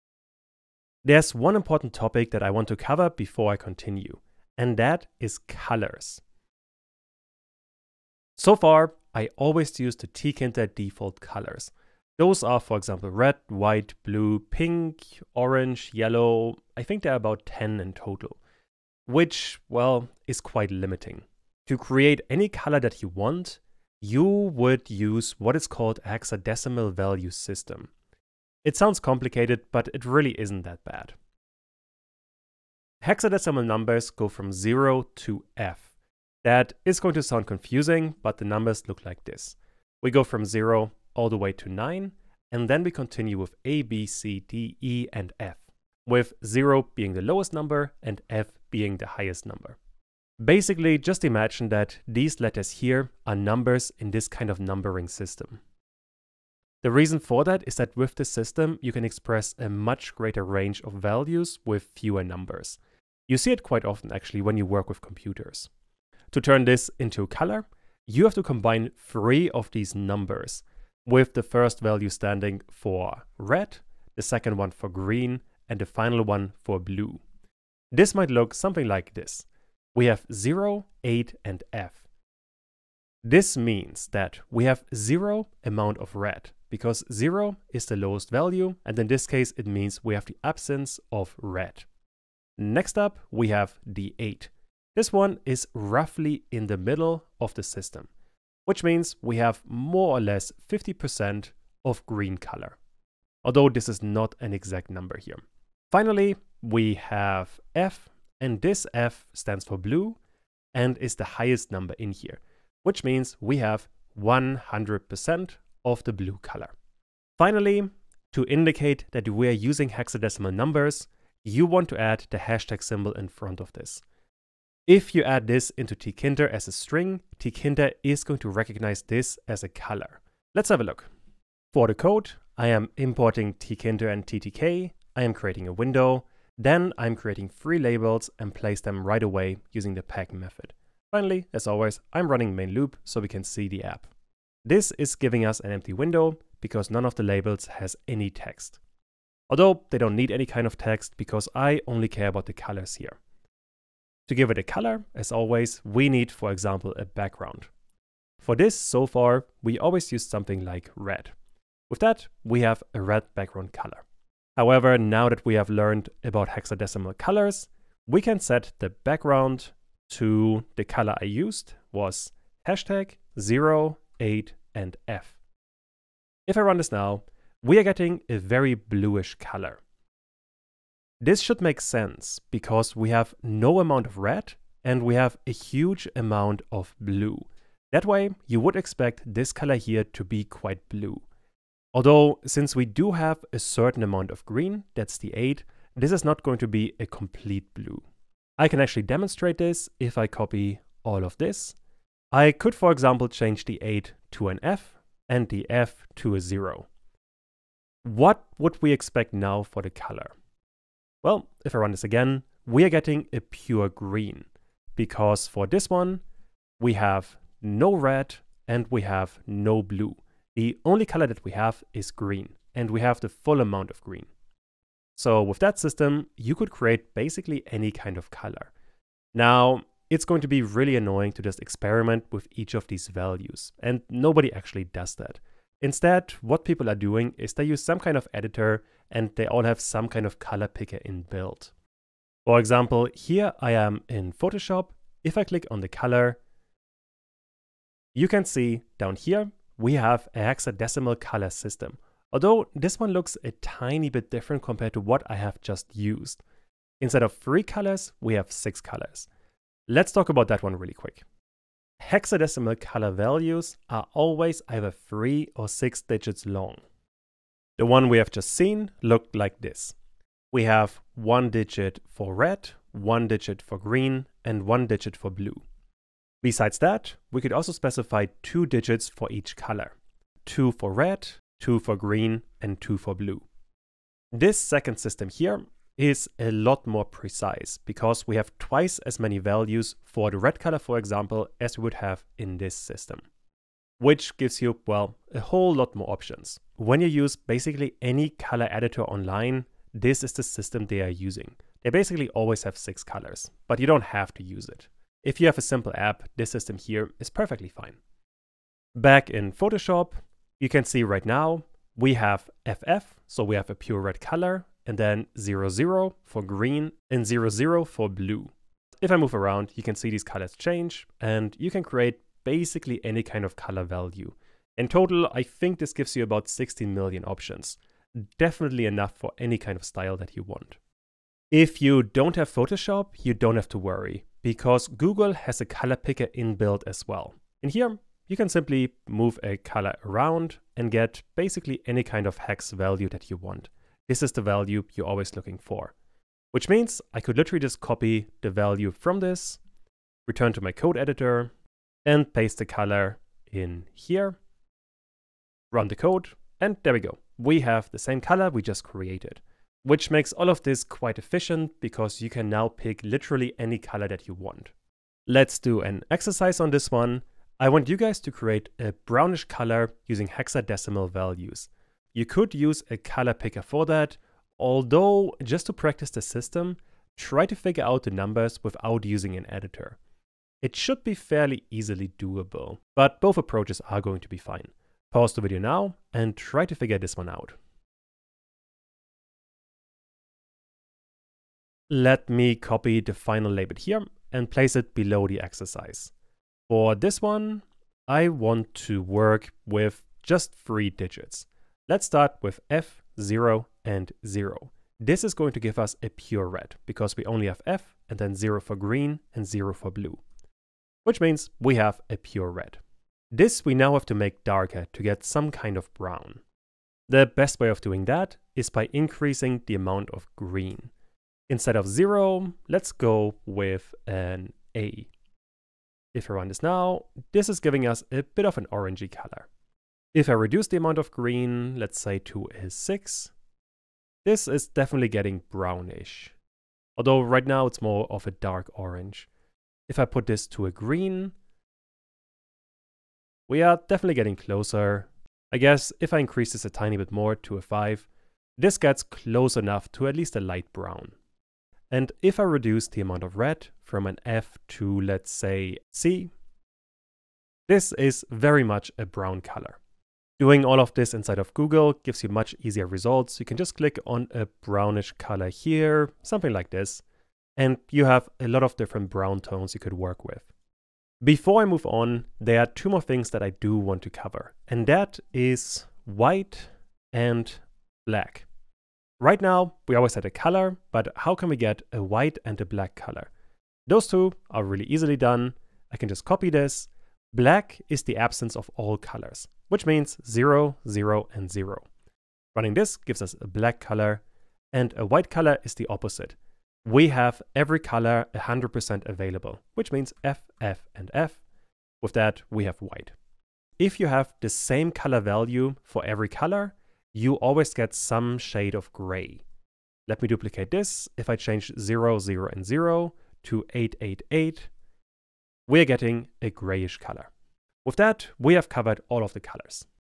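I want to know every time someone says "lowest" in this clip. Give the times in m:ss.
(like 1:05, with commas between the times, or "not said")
0:47, 1:27.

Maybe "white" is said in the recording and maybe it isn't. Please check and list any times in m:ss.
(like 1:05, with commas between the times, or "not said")
0:13, 7:56, 8:02, 8:15, 8:22.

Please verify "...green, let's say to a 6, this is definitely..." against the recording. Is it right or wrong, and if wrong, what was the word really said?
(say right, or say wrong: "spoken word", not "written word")
right.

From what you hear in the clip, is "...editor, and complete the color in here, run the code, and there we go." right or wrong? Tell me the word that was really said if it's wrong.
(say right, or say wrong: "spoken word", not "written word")
wrong: "paste", not "complete".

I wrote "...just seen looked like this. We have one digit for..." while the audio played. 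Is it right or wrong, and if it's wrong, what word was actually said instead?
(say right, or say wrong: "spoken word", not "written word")
right.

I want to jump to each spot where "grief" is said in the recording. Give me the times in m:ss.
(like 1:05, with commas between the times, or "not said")
not said.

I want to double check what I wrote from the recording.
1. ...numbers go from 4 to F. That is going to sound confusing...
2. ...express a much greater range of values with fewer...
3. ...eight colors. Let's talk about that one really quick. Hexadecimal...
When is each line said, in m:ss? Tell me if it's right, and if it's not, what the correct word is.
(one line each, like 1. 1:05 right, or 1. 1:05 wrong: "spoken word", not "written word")
1. 0:33 wrong: "0", not "4"
2. 0:59 right
3. 4:18 wrong: "six", not "eight".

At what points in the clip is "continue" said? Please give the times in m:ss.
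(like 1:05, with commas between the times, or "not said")
0:03, 0:42.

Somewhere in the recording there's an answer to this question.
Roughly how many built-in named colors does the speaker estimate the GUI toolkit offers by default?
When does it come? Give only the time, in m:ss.
0:17.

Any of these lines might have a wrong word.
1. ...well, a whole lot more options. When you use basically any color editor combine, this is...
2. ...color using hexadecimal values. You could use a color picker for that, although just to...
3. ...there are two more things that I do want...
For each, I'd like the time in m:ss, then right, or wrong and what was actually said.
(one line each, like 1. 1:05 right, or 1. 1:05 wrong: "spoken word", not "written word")
1. 4:54 wrong: "online", not "combine"
2. 6:09 right
3. 7:52 right.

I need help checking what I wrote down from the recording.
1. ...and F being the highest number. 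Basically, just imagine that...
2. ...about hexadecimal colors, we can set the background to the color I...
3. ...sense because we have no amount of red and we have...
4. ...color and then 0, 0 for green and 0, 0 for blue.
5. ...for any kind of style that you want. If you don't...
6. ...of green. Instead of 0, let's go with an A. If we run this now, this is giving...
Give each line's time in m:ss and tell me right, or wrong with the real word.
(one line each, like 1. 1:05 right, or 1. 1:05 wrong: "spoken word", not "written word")
1. 0:48 right
2. 2:46 right
3. 3:01 right
4. 5:14 right
5. 5:29 right
6. 7:00 right.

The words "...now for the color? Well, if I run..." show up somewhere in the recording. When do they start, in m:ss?
3:29.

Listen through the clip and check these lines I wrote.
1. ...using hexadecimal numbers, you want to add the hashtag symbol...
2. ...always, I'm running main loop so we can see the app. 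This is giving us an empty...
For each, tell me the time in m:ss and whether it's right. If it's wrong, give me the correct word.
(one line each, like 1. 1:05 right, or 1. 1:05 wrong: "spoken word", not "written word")
1. 1:59 right
2. 2:21 right.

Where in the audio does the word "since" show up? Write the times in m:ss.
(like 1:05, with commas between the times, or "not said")
3:12.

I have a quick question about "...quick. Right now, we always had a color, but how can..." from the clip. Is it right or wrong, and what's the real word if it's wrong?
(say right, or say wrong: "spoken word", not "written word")
wrong: "black", not "quick".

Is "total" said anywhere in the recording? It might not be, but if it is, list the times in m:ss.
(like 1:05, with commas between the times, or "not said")
0:17, 5:24.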